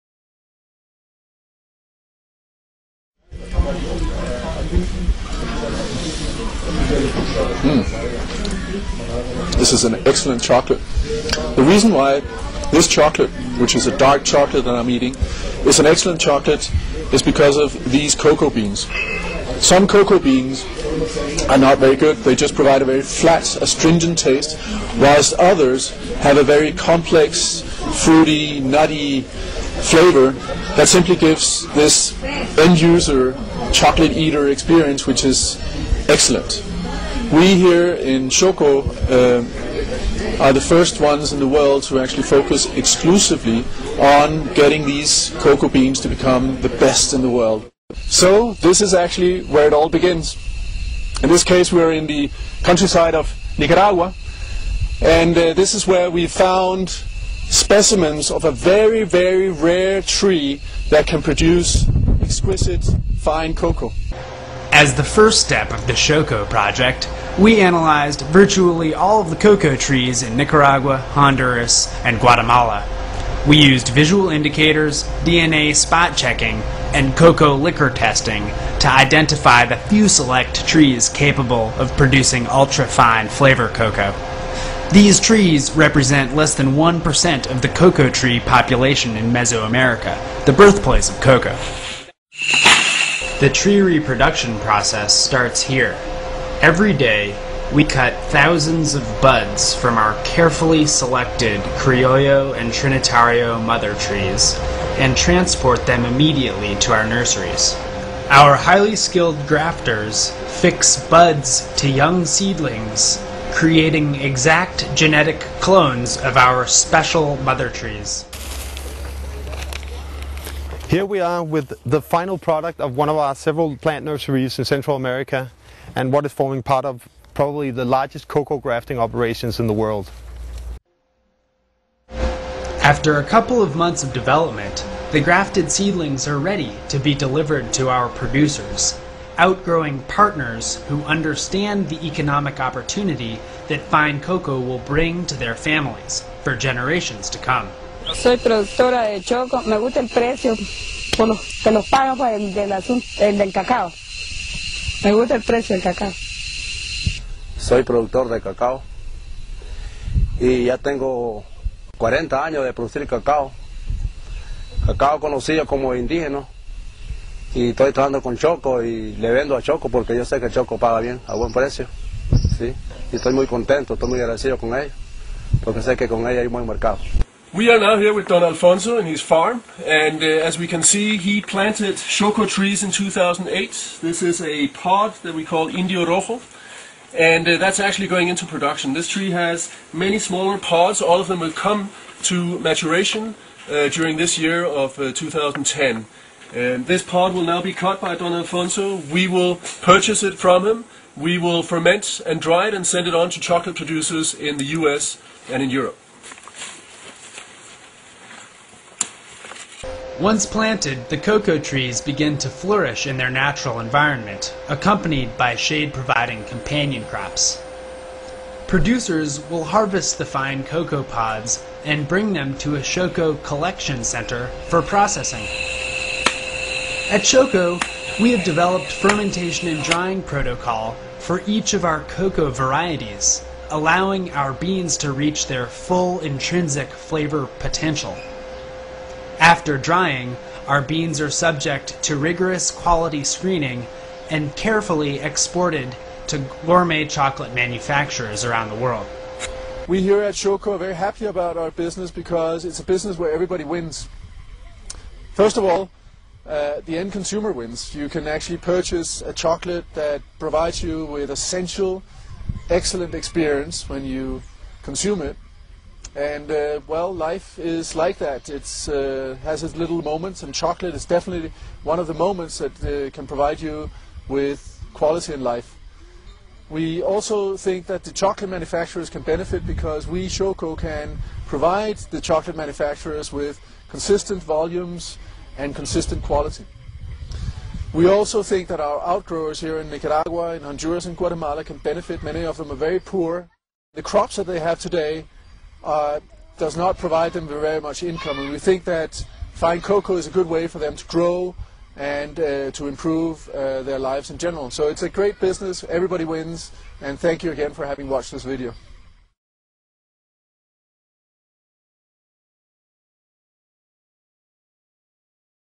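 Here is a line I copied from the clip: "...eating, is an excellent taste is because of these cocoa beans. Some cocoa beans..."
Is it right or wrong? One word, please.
wrong.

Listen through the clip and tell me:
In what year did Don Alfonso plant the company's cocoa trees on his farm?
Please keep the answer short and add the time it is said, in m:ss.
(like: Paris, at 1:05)
2008, at 3:02.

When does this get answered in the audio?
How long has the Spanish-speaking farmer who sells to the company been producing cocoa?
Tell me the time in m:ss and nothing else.
2:41.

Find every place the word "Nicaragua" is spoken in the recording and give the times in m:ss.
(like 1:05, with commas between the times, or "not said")
0:53, 1:10, 4:49.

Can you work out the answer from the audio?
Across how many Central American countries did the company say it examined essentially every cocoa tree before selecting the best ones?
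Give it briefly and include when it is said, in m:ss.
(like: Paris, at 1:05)
3, at 1:10.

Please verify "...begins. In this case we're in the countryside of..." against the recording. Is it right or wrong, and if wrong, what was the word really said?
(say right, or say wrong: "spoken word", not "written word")
right.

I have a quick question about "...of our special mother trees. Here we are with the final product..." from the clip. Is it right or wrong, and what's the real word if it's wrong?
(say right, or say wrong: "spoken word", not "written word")
right.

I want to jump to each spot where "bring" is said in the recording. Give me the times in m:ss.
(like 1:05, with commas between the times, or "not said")
2:24, 3:42.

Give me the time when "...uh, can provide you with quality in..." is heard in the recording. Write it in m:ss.
4:32.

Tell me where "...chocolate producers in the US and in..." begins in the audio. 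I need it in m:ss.
3:23.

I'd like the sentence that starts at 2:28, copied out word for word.
Soy productora de choco, me gusta el precio los, que los pagan pues, por el del, cacao.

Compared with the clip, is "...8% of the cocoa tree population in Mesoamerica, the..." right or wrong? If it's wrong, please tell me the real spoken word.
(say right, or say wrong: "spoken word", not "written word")
wrong: "1", not "8".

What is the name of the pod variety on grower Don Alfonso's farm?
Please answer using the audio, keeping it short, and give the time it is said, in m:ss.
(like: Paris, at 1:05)
Indio Rojo, at 3:05.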